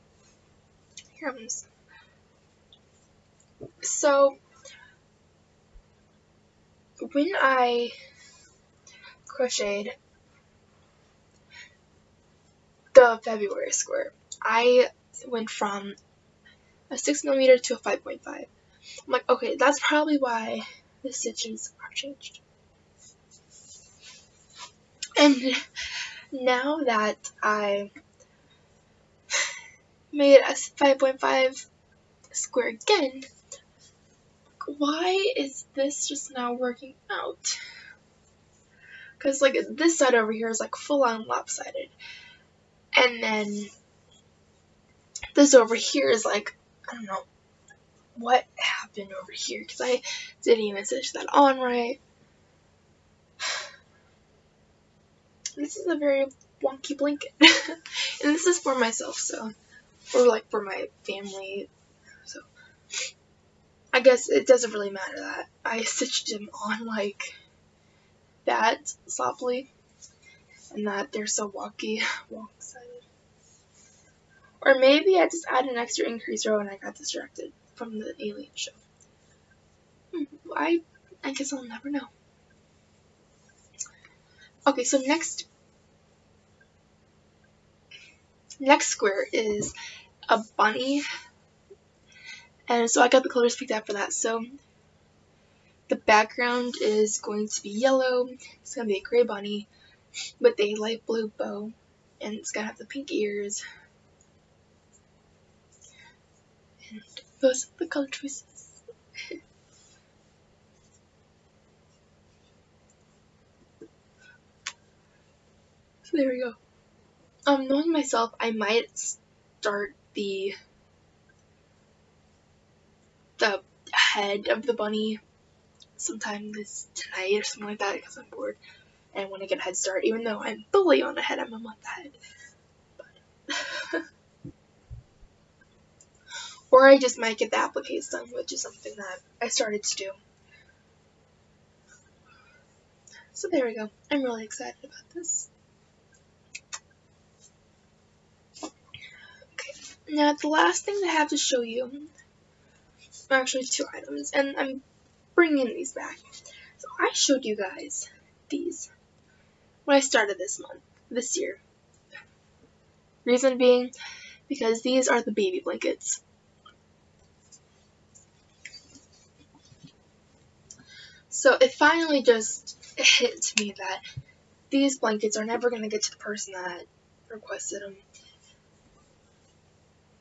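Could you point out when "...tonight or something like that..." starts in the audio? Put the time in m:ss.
2:06.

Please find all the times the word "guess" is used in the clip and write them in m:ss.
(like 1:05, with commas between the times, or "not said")
1:03, 1:21.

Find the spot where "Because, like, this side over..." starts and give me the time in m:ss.
0:39.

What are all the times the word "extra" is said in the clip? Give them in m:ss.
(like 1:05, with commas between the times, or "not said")
1:15.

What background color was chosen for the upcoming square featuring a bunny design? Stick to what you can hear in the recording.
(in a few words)
Yellow.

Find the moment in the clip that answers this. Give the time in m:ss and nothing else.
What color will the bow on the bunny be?
1:40.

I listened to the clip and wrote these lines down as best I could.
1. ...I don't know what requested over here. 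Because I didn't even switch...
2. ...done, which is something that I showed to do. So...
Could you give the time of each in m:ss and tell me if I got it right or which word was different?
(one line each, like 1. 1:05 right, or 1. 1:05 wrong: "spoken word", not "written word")
1. 0:46 wrong: "happened", not "requested"
2. 2:18 wrong: "started", not "showed".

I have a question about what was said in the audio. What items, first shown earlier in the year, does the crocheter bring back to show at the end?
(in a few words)
Baby blankets.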